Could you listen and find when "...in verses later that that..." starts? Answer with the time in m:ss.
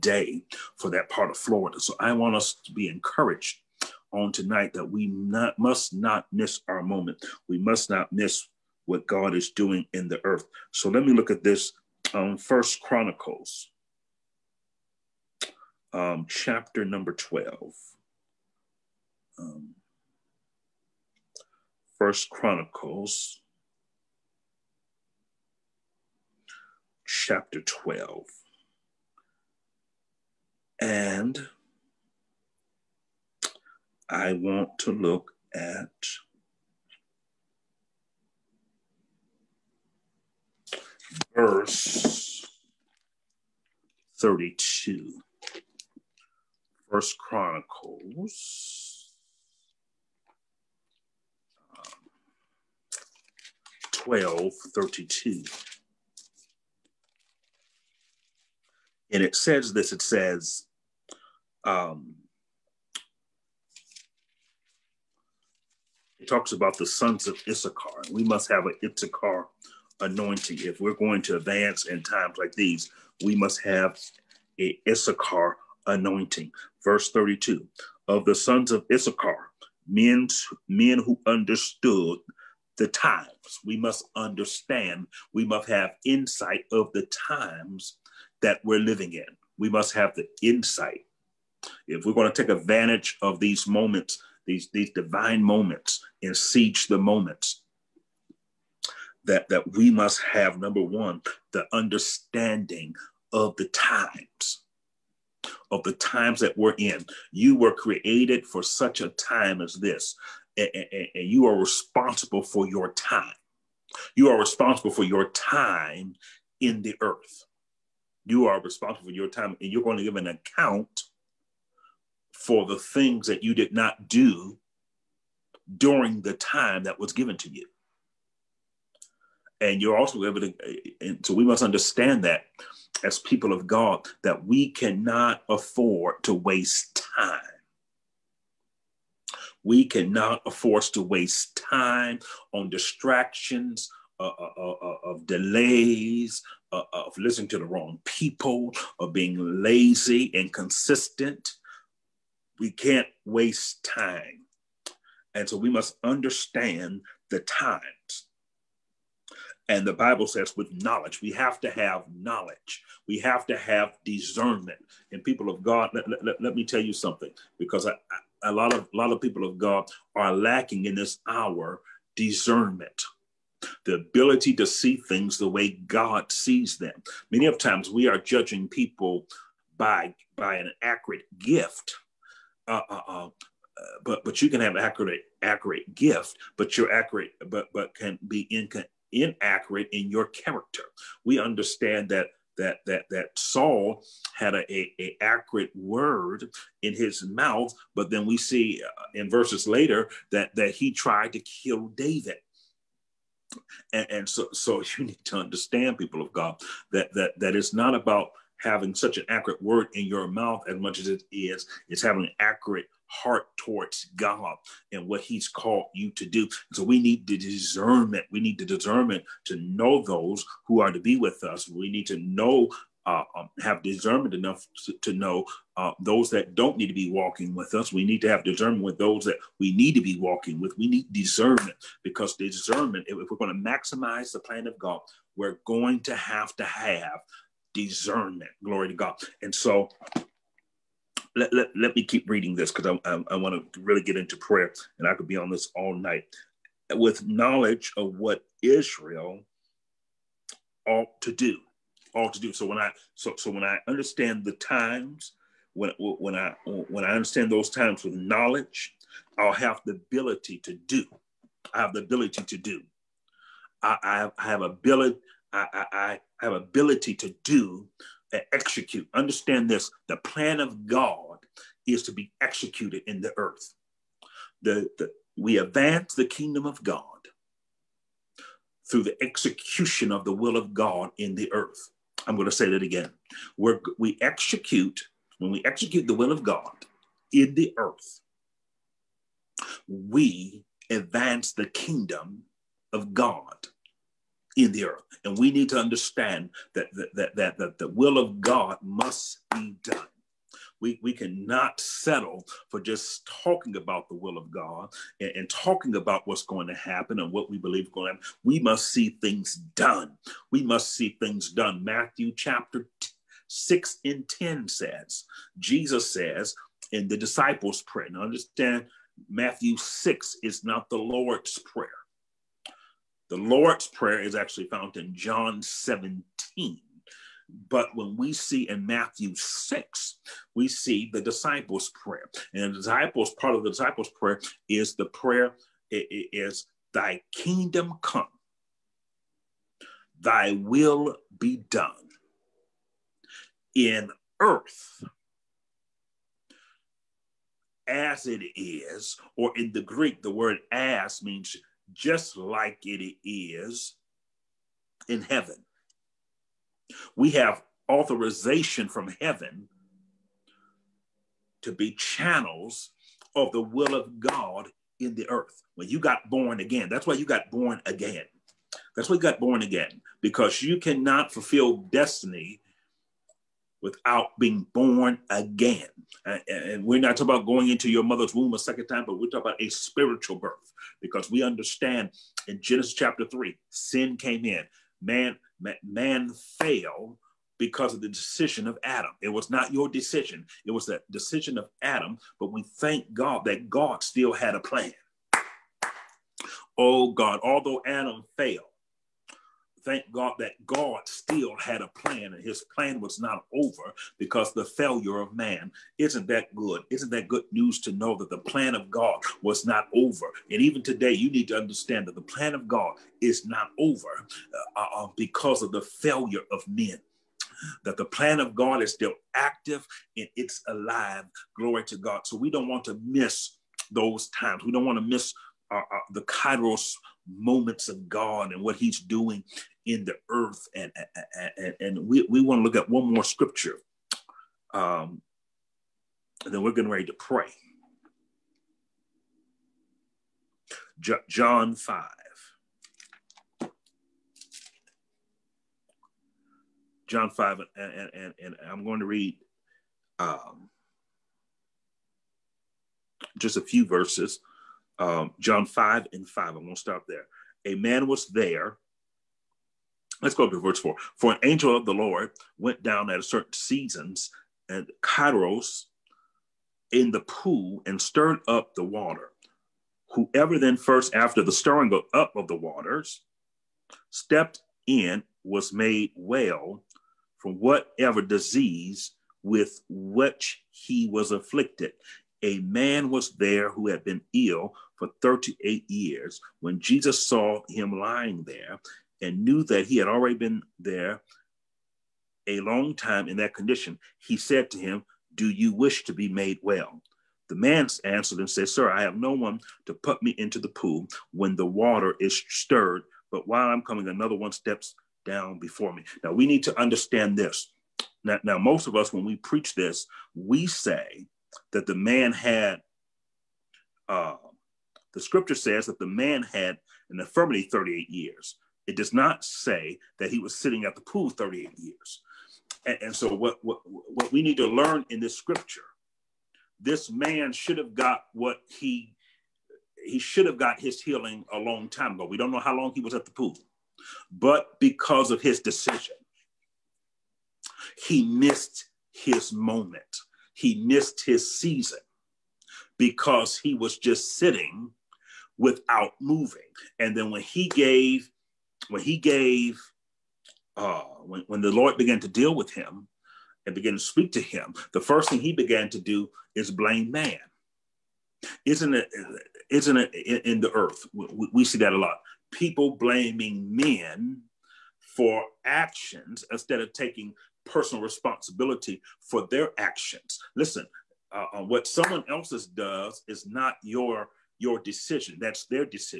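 3:19.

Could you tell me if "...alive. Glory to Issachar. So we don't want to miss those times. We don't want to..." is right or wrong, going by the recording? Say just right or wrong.
wrong.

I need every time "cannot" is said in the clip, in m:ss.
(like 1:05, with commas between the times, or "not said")
2:14, 2:19, 5:01, 6:10.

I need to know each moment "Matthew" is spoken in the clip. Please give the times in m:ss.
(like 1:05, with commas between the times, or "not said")
5:11, 5:19, 5:28.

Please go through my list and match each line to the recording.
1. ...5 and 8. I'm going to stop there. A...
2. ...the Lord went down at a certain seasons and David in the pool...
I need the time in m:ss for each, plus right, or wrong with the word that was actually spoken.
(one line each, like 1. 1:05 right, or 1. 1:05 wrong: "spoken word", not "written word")
1. 7:35 wrong: "5", not "8"
2. 7:41 wrong: "Kairos", not "David".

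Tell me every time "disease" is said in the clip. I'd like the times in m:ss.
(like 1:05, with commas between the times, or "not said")
7:58.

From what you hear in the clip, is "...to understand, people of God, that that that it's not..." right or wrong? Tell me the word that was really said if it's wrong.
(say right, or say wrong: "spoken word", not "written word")
right.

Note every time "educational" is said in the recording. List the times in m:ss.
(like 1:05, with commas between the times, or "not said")
not said.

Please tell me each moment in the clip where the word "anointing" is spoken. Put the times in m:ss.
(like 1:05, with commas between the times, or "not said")
1:09, 1:15.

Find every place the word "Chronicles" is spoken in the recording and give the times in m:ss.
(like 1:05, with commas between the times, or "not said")
0:12, 0:22, 0:47.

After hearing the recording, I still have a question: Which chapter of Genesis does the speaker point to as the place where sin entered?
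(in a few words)
Chapter 3.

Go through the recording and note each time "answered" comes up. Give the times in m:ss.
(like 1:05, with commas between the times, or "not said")
8:18.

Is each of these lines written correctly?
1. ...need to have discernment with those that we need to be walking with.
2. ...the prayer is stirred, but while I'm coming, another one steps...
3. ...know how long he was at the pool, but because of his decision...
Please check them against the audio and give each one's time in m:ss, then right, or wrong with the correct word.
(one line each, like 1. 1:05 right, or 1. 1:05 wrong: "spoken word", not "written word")
1. 3:48 right
2. 8:21 wrong: "water", not "prayer"
3. 8:52 right.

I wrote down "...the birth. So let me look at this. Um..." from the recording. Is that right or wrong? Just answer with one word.
wrong.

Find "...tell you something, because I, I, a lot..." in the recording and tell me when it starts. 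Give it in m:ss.
2:46.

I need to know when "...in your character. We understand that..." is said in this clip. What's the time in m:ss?
3:09.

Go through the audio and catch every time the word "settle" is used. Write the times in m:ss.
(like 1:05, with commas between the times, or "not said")
5:01.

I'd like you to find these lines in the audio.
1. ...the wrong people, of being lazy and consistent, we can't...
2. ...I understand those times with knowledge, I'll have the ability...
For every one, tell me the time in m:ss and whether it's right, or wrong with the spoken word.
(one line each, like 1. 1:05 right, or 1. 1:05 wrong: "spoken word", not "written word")
1. 2:27 right
2. 4:17 right.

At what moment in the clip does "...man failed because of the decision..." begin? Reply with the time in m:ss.
6:25.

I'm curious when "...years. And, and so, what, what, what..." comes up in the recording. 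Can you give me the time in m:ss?
8:41.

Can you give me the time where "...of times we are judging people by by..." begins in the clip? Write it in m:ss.
2:57.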